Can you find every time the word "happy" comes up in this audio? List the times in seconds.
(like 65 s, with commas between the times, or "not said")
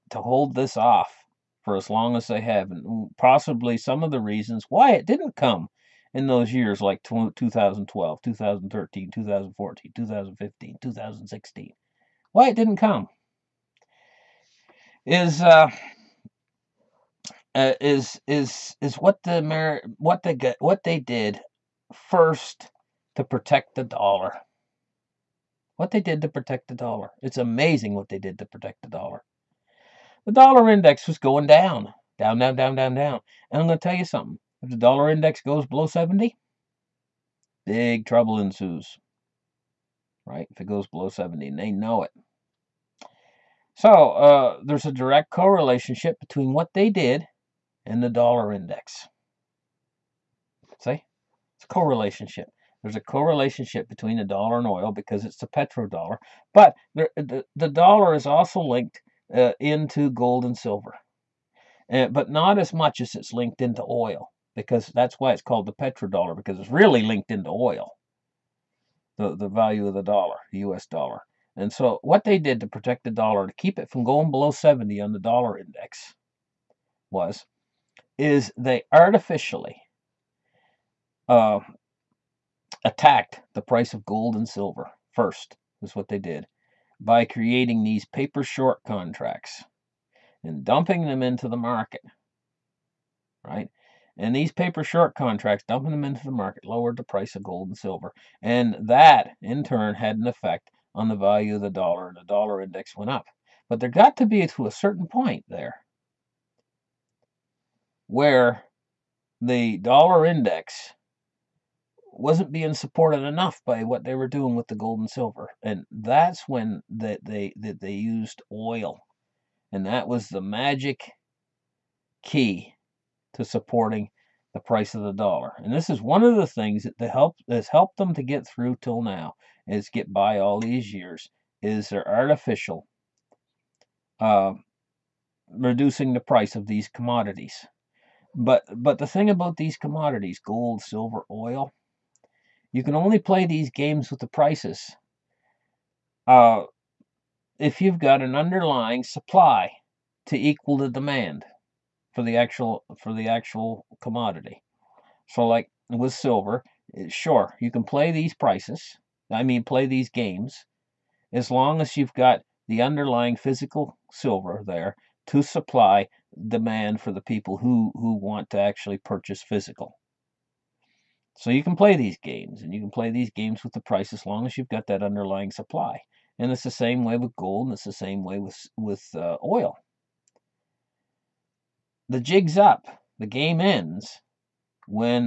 not said.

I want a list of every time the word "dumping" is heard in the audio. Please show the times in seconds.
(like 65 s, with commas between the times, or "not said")
90 s, 95 s.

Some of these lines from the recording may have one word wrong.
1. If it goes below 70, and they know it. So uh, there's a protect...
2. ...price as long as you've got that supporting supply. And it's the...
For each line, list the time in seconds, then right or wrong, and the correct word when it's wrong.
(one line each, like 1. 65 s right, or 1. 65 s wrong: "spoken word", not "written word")
1. 40 s wrong: "direct", not "protect"
2. 173 s wrong: "underlying", not "supporting".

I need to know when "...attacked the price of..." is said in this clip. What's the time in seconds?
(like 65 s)
82 s.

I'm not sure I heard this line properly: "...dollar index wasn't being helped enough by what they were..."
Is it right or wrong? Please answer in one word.
wrong.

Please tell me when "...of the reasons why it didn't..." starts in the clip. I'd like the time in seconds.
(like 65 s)
4 s.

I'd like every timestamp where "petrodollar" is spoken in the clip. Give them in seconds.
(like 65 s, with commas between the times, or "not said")
55 s, 65 s.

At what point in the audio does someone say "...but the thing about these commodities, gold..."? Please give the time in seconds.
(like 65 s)
138 s.